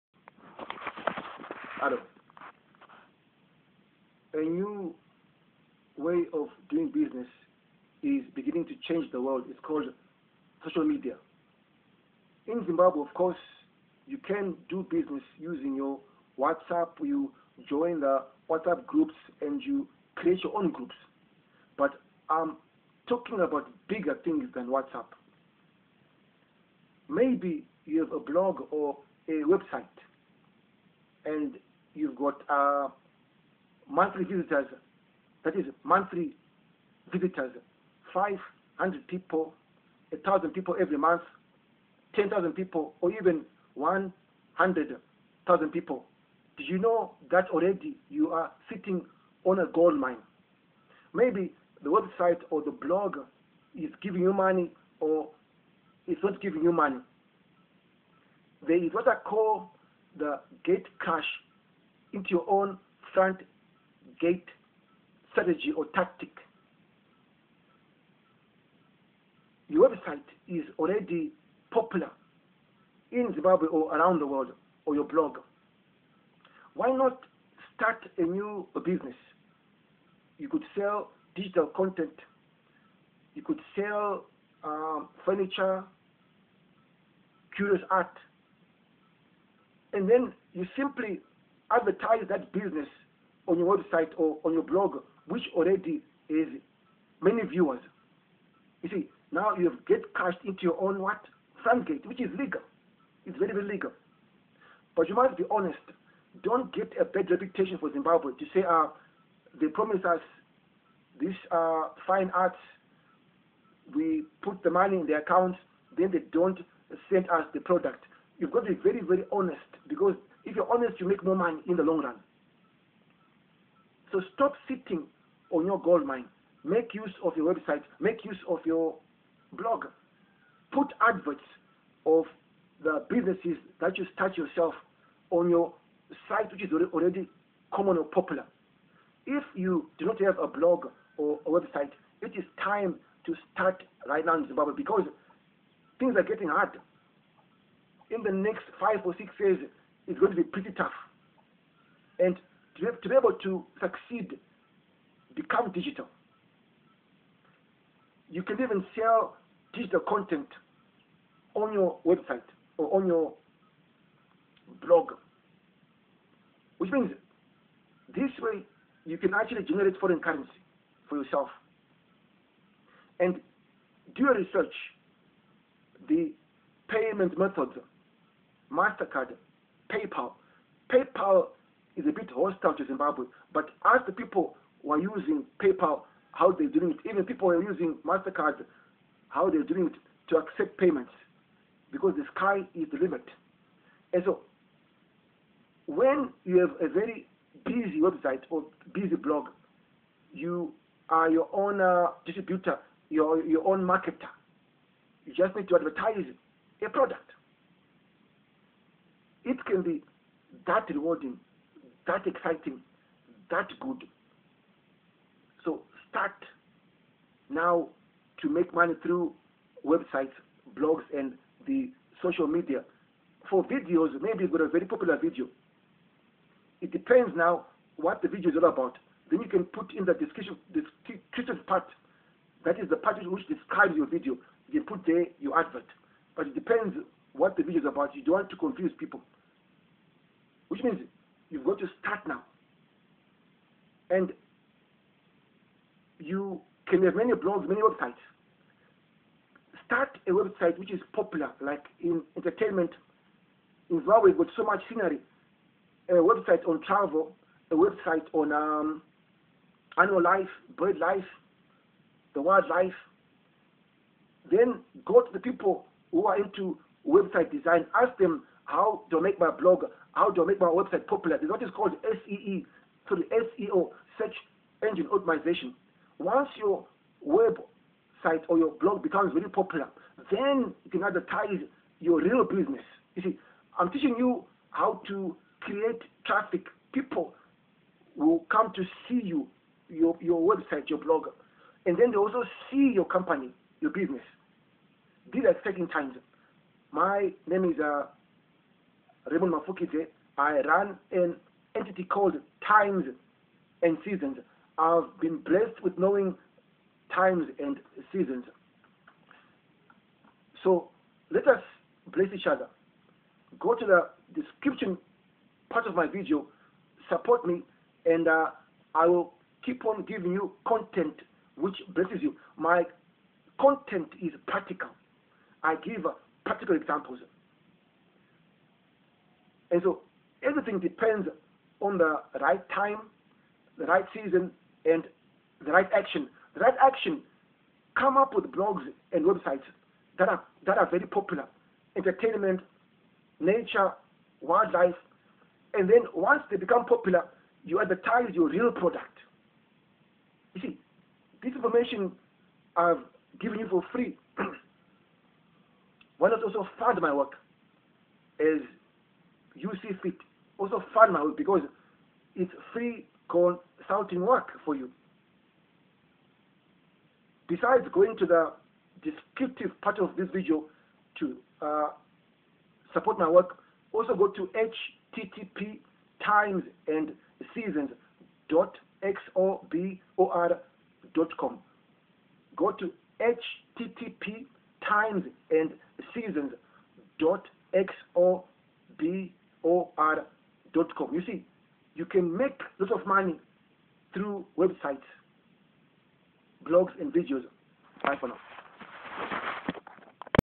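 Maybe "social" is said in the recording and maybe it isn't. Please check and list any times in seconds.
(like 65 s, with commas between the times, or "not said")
10 s, 222 s.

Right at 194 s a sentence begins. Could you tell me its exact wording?
And so, when you have a very busy website or busy blog, you are your own uh, distributor, your, your own marketer.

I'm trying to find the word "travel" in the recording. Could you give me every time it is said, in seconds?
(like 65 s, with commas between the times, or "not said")
256 s.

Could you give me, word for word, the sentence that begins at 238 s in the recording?
You don't want to confuse people.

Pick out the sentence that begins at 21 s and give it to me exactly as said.
But I'm talking about bigger things than WhatsApp.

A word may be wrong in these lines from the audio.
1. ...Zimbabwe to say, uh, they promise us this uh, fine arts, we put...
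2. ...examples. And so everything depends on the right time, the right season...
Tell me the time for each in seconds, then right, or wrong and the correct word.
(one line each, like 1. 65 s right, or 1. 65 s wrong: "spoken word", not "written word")
1. 107 s right
2. 326 s right.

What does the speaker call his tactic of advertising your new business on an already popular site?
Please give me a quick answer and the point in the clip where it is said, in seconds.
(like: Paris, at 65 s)
gate cash into your own front gate, at 60 s.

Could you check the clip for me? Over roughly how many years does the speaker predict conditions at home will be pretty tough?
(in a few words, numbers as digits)
5 or 6.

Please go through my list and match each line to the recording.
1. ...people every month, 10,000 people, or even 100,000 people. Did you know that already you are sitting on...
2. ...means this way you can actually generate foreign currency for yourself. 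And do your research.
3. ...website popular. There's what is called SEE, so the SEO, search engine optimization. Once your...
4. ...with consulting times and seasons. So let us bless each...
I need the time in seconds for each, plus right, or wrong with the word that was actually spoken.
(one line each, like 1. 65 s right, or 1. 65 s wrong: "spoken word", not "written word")
1. 40 s right
2. 166 s right
3. 270 s right
4. 305 s wrong: "knowing", not "consulting".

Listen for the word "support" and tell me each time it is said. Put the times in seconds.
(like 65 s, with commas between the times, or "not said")
317 s, 372 s.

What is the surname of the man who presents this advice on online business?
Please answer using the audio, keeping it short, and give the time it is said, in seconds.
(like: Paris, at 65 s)
Mafukidze, at 299 s.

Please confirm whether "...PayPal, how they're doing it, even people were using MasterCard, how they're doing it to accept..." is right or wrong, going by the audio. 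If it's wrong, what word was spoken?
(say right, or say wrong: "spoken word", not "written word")
right.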